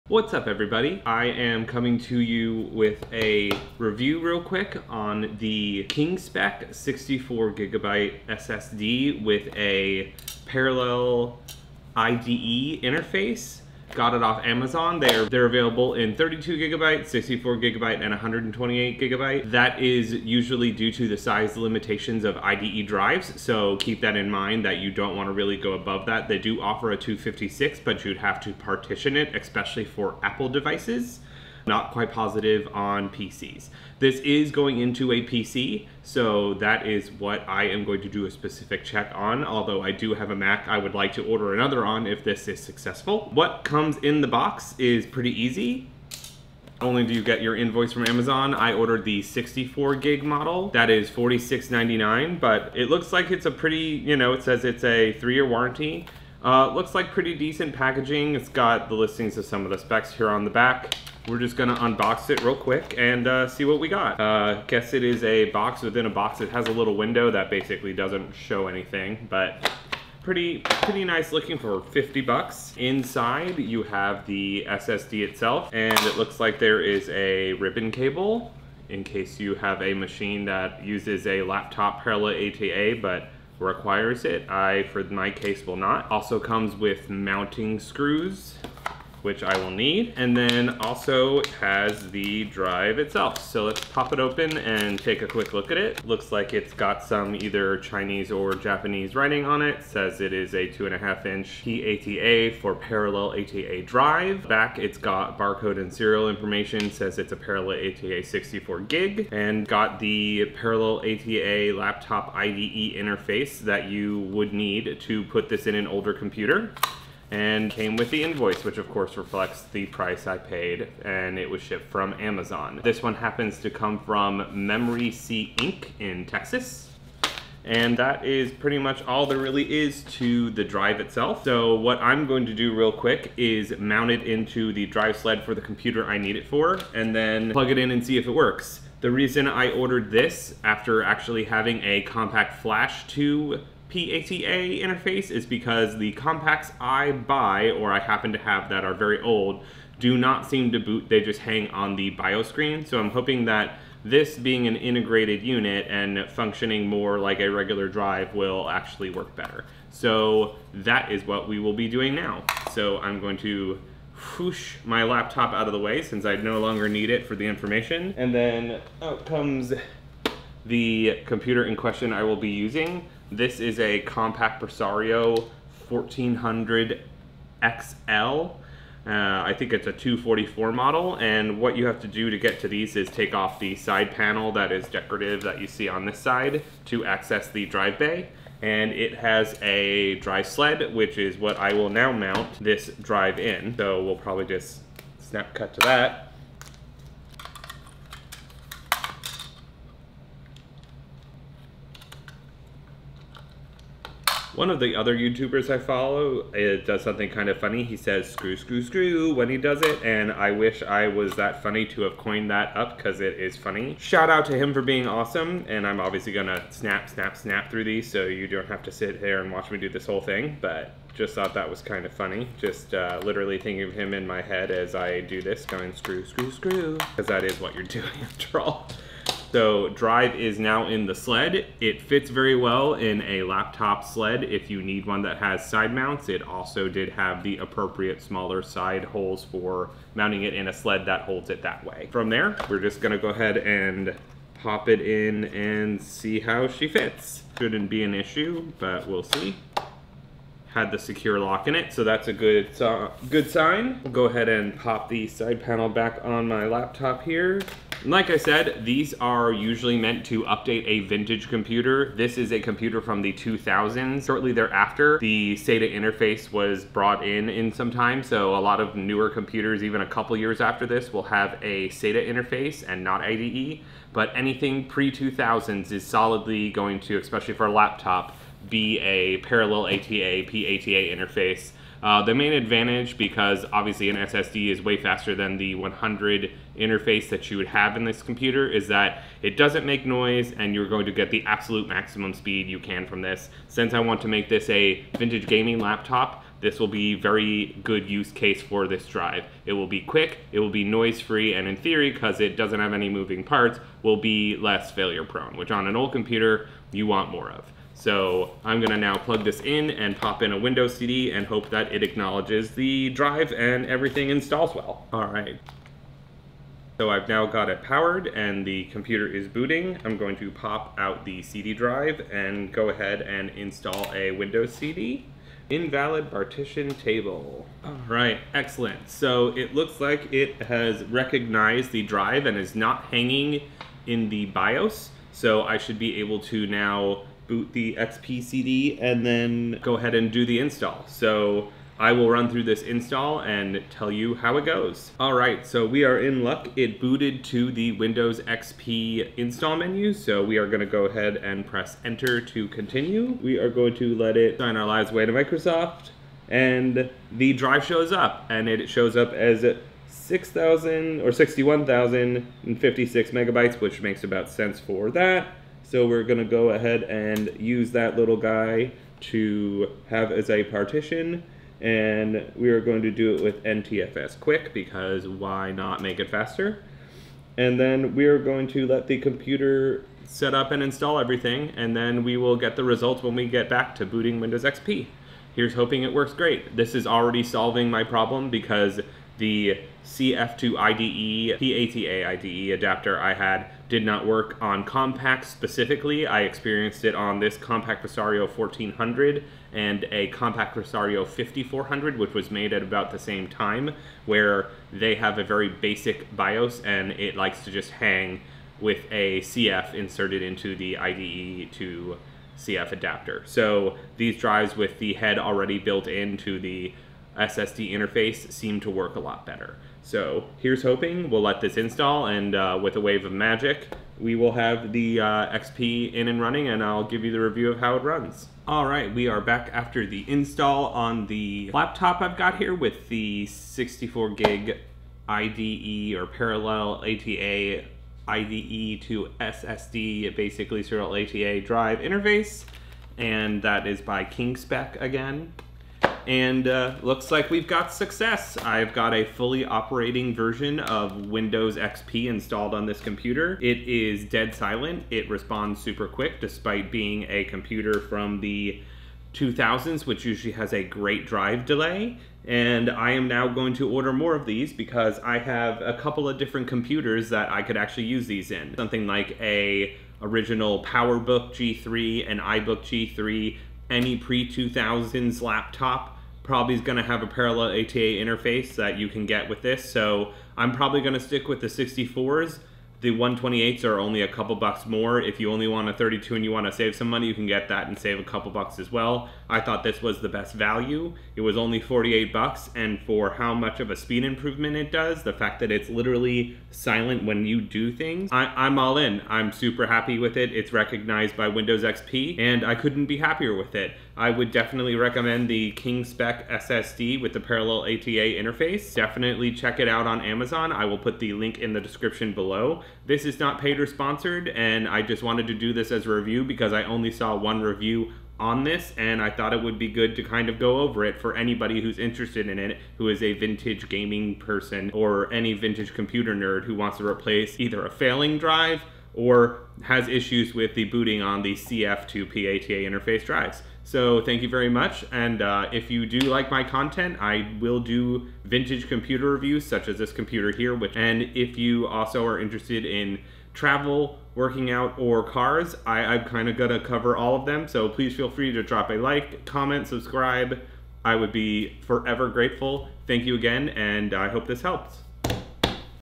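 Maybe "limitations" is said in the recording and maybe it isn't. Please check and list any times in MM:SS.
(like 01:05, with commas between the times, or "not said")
00:21.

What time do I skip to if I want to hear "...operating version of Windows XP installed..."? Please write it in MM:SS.
07:29.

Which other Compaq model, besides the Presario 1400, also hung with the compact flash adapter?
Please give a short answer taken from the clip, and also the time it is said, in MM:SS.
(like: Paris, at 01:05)
Compaq Presario 5400, at 06:40.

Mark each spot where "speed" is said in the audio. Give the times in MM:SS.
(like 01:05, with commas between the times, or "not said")
04:52, 08:13.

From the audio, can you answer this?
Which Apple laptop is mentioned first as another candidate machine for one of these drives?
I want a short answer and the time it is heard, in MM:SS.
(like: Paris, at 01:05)
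PowerBook G3, at 07:50.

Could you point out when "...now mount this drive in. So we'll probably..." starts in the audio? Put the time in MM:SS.
03:11.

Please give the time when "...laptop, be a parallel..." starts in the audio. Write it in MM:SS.
04:37.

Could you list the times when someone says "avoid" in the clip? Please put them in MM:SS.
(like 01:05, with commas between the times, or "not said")
not said.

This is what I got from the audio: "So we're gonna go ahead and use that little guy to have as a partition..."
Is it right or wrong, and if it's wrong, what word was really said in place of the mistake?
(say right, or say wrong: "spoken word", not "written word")
right.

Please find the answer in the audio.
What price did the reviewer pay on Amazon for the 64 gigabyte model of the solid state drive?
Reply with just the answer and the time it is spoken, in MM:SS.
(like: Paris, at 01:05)
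$46.99, at 00:51.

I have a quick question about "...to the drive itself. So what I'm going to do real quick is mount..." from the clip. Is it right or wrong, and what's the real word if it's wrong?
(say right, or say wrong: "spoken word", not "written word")
right.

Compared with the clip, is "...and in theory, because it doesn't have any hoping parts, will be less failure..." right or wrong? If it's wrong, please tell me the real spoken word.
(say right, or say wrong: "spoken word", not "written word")
wrong: "moving", not "hoping".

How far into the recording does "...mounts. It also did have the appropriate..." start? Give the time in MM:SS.
03:55.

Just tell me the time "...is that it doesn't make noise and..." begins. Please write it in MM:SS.
04:48.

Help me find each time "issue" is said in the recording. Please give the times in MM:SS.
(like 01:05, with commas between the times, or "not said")
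04:08, 08:50.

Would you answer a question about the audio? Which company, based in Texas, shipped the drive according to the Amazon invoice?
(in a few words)
Memory C Inc.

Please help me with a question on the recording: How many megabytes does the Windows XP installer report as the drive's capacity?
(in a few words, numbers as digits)
61,056.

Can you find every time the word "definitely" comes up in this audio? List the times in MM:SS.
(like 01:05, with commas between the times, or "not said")
08:24, 08:28.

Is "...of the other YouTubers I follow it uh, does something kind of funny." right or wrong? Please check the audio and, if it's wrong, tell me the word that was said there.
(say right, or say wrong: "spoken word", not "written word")
right.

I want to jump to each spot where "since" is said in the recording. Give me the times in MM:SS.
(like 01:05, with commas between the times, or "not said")
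02:46, 04:53.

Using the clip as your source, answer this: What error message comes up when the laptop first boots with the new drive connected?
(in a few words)
Invalid partition table.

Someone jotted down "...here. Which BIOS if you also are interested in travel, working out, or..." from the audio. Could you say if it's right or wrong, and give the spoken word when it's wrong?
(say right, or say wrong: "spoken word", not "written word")
wrong: "And", not "BIOS".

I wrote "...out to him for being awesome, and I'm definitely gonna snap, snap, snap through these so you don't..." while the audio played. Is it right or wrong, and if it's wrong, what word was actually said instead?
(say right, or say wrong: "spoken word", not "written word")
wrong: "obviously", not "definitely".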